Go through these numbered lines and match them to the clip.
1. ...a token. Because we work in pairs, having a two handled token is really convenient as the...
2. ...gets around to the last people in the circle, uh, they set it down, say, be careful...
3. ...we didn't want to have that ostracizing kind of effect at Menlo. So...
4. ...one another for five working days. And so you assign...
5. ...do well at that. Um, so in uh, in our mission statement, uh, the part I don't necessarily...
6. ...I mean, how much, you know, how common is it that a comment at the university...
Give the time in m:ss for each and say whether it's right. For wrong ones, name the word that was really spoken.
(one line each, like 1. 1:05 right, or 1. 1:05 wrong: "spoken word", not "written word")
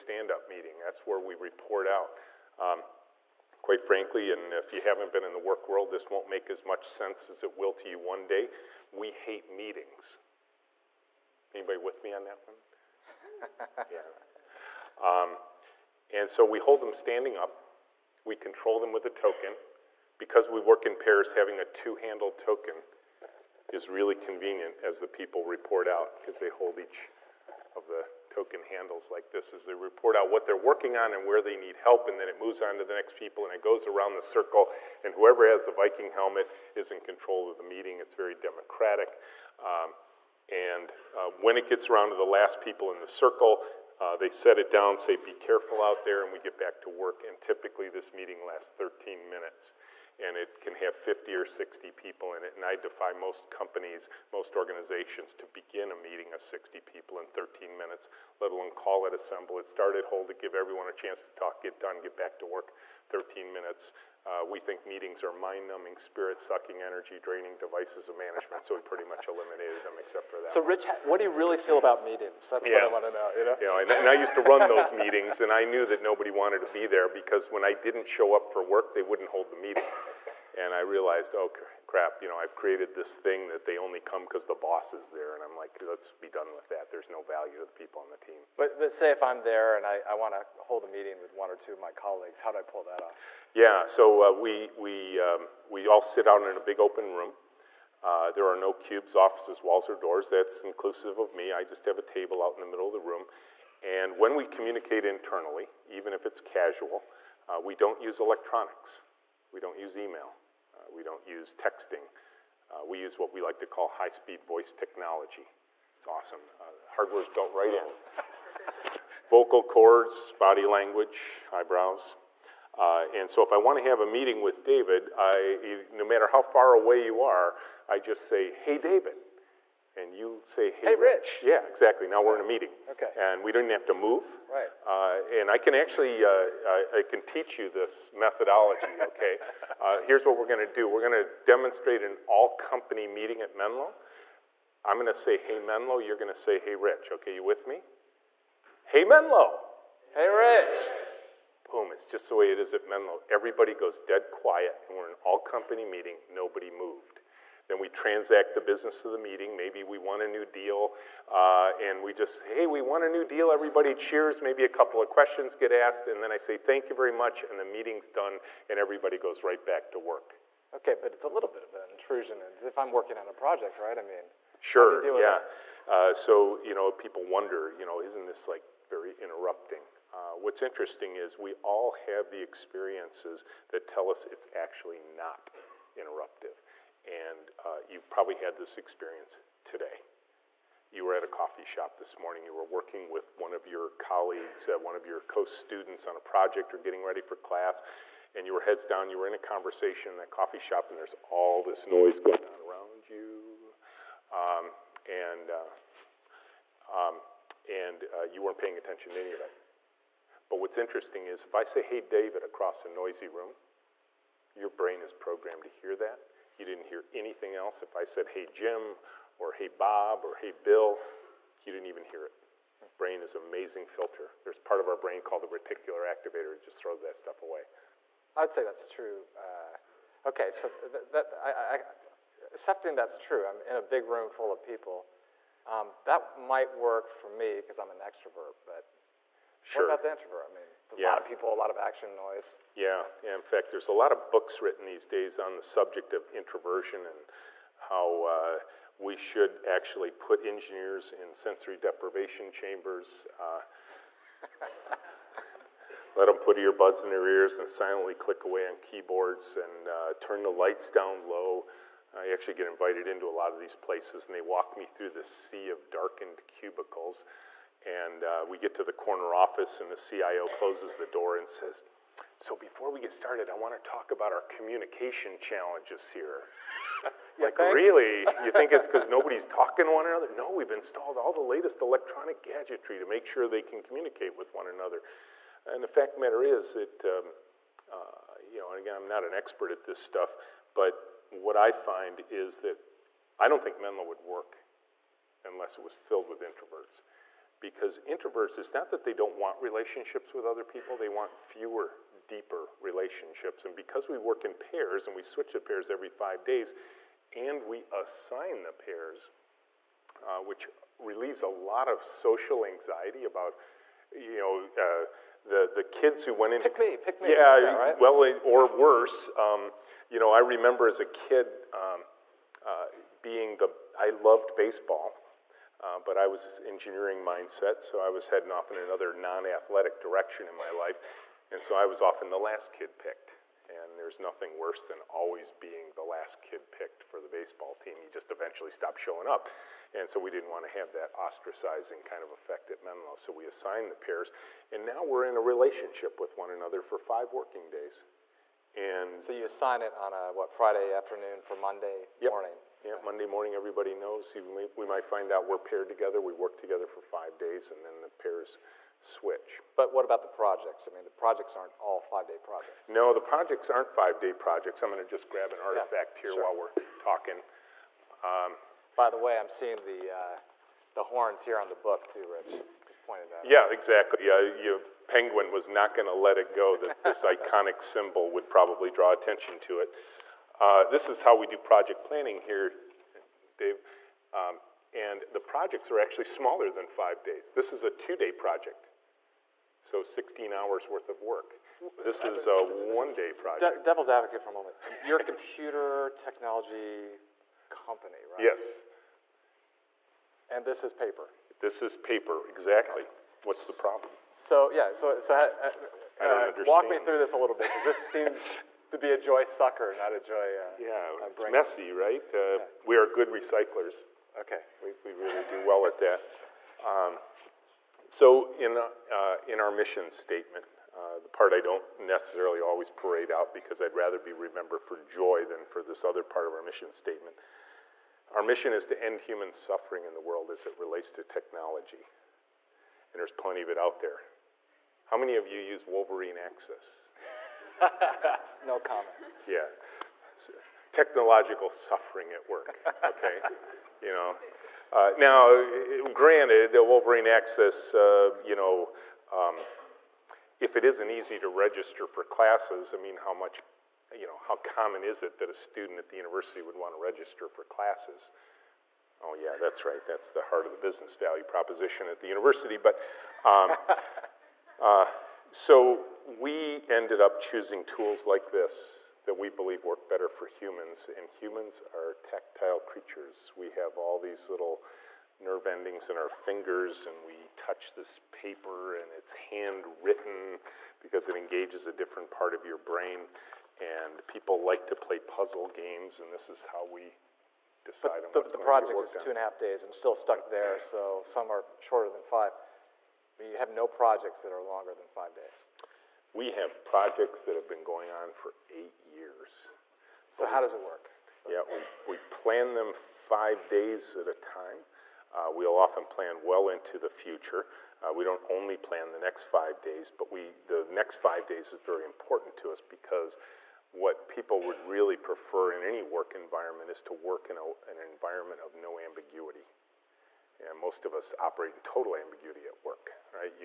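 1. 0:19 right
2. 0:41 right
3. 5:40 right
4. 5:46 right
5. 6:55 right
6. 7:32 wrong: "student", not "comment".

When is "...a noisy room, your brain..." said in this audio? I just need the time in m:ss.
3:32.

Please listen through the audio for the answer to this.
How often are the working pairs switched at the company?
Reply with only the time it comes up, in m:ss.
5:05.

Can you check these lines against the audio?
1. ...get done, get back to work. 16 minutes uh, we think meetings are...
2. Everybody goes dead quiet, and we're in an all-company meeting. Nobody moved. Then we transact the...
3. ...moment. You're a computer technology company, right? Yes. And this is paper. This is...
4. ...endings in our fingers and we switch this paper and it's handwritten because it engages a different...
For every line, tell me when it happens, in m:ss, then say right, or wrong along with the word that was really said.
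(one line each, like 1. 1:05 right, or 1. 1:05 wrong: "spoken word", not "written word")
1. 1:01 wrong: "13", not "16"
2. 2:33 right
3. 6:34 right
4. 7:55 wrong: "touch", not "switch".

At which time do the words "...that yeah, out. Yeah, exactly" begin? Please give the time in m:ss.
6:13.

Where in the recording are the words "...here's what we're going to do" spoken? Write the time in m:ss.
2:20.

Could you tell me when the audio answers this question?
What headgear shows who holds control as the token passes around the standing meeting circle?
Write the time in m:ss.
0:35.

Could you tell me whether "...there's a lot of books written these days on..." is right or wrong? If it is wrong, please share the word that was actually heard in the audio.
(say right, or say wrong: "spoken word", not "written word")
right.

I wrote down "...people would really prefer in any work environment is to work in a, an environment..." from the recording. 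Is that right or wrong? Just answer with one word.
right.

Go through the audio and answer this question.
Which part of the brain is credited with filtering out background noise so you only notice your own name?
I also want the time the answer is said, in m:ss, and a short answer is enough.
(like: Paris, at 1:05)
reticular activator, at 3:45.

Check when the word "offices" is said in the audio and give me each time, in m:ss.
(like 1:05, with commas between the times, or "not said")
1:39, 4:29.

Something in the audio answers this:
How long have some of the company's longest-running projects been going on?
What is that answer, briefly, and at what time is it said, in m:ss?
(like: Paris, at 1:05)
8 years, at 8:18.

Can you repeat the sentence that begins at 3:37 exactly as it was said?
If I said, hey, Jim, or hey, Bob, or hey, Bill, you didn't even hear it.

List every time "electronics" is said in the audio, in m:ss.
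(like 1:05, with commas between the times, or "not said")
1:48, 4:41.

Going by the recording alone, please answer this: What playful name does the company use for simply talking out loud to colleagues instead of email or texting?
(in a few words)
high-speed voice technology.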